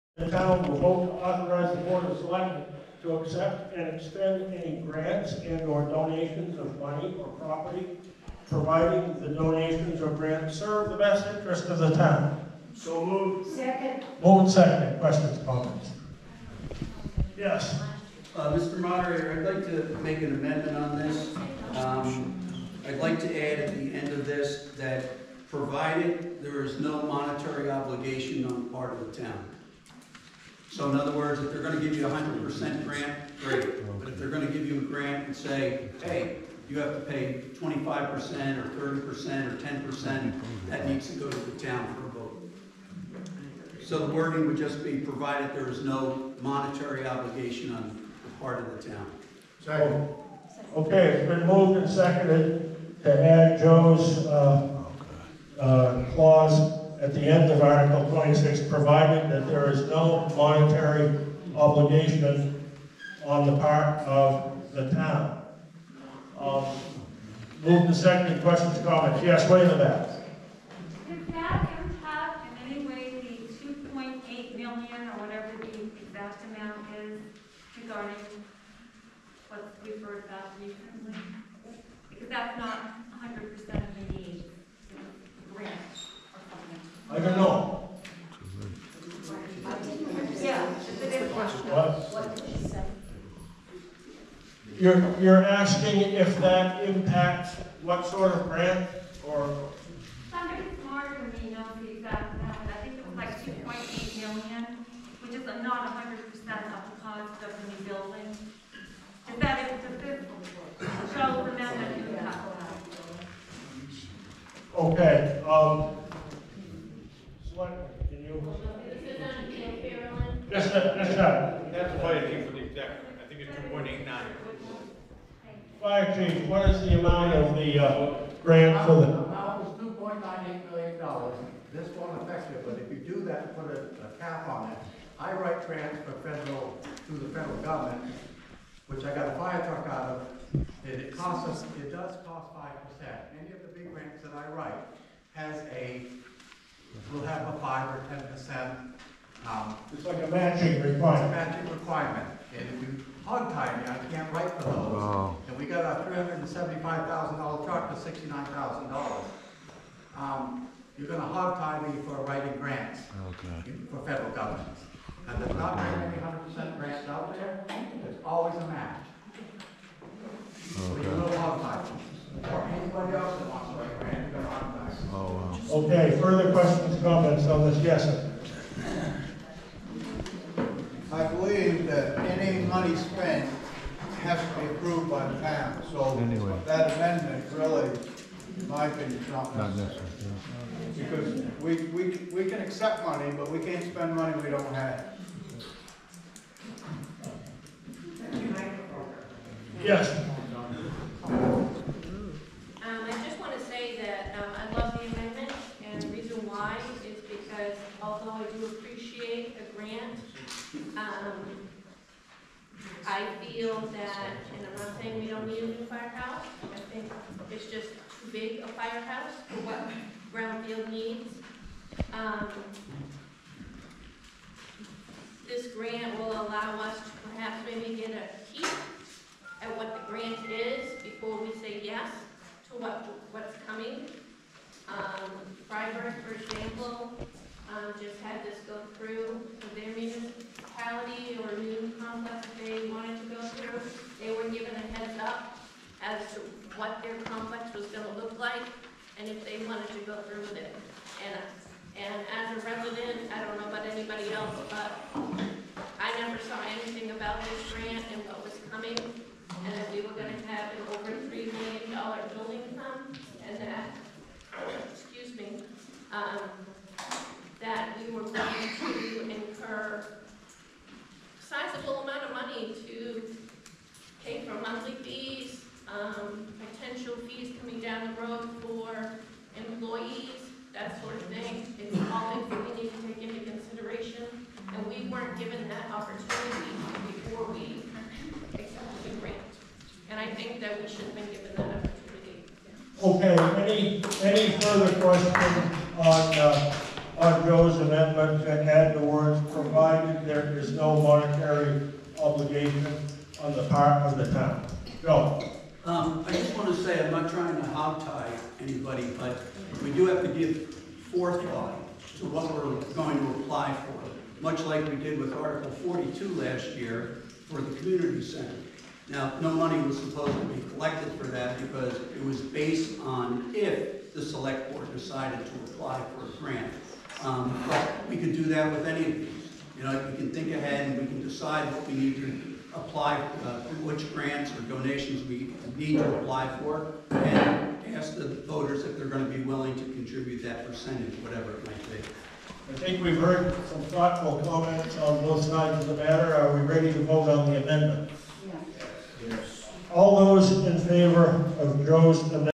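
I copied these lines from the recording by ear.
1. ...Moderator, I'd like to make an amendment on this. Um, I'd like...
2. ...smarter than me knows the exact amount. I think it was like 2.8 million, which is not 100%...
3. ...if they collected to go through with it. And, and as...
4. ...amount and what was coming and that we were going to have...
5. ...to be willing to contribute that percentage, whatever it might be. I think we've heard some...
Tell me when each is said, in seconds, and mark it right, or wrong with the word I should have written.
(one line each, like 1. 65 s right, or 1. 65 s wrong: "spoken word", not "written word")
1. 18 s right
2. 100 s right
3. 249 s wrong: "wanted", not "collected"
4. 257 s wrong: "grant", not "amount"
5. 339 s right.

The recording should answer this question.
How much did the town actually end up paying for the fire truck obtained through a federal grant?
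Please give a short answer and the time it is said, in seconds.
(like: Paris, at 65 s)
$69,000, at 158 s.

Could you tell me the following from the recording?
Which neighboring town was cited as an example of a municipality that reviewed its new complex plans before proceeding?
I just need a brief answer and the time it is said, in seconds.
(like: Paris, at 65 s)
Fryeburg, at 235 s.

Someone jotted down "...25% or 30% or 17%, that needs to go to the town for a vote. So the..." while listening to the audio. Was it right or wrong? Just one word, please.
wrong.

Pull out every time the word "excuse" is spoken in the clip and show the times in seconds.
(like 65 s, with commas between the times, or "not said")
264 s.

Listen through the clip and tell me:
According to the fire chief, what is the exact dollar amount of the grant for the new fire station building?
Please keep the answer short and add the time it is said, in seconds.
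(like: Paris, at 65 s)
$2.98 million, at 129 s.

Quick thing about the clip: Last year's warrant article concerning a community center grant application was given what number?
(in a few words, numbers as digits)
Article 42.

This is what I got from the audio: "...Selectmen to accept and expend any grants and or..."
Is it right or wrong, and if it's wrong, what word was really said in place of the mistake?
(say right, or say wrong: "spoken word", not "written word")
right.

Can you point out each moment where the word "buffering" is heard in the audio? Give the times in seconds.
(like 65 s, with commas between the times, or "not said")
not said.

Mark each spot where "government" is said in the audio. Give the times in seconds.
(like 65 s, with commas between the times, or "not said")
137 s, 164 s.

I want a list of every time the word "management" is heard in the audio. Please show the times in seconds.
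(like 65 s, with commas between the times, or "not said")
not said.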